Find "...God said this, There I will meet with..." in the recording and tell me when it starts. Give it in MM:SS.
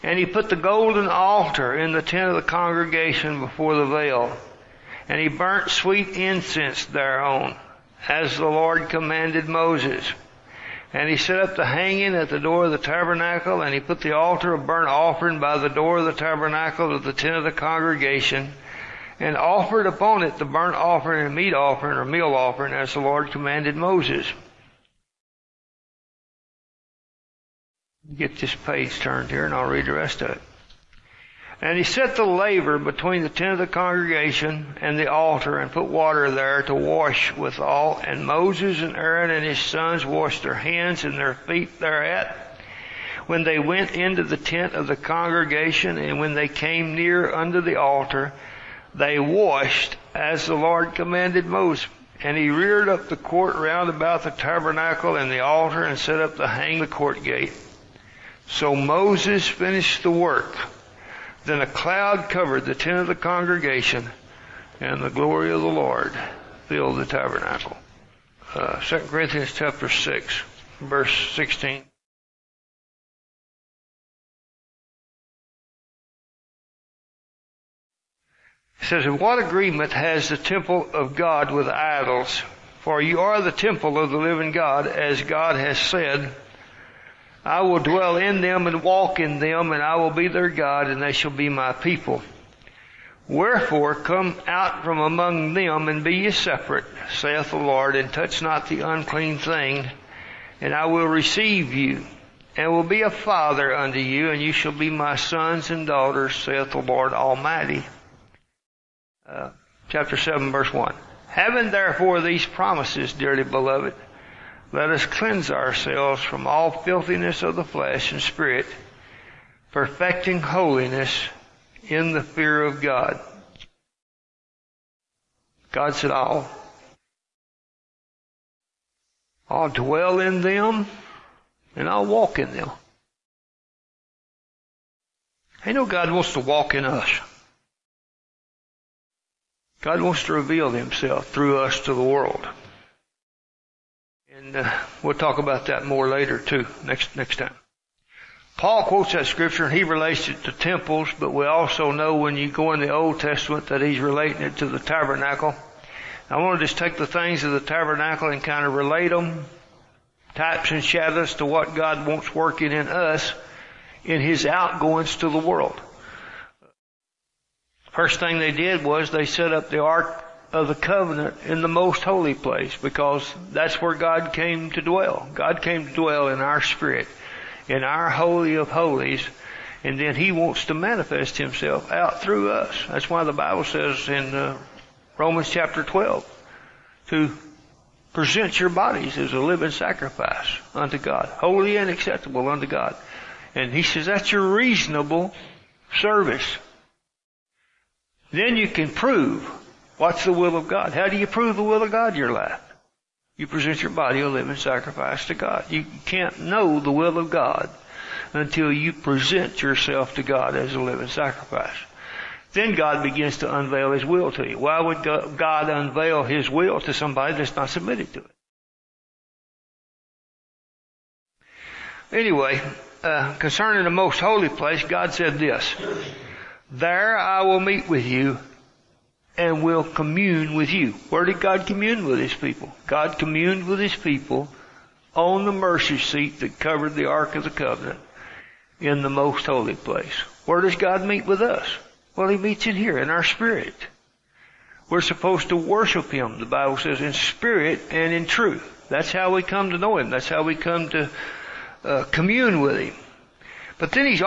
03:44.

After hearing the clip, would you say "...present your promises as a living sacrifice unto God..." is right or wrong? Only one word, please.
wrong.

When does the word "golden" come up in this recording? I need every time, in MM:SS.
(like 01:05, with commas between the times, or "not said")
00:00.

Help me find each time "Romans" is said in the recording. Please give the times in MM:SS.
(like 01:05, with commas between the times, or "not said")
03:05.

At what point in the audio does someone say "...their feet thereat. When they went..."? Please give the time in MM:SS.
00:41.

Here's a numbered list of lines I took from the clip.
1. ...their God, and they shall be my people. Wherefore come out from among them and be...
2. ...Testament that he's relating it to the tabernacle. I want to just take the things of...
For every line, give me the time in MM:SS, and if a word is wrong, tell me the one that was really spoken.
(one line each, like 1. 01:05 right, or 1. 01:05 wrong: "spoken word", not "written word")
1. 01:30 right
2. 02:33 right.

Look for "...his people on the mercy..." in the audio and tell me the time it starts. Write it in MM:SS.
03:53.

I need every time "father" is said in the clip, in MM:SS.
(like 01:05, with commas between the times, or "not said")
01:43.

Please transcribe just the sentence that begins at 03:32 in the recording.
Then God begins to unveil His will to you.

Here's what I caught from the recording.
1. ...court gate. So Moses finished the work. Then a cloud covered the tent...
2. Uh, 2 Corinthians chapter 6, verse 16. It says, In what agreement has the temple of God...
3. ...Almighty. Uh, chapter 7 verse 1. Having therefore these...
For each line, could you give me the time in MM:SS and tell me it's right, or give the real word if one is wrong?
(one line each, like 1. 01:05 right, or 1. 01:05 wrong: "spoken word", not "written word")
1. 00:56 right
2. 01:08 right
3. 01:47 right.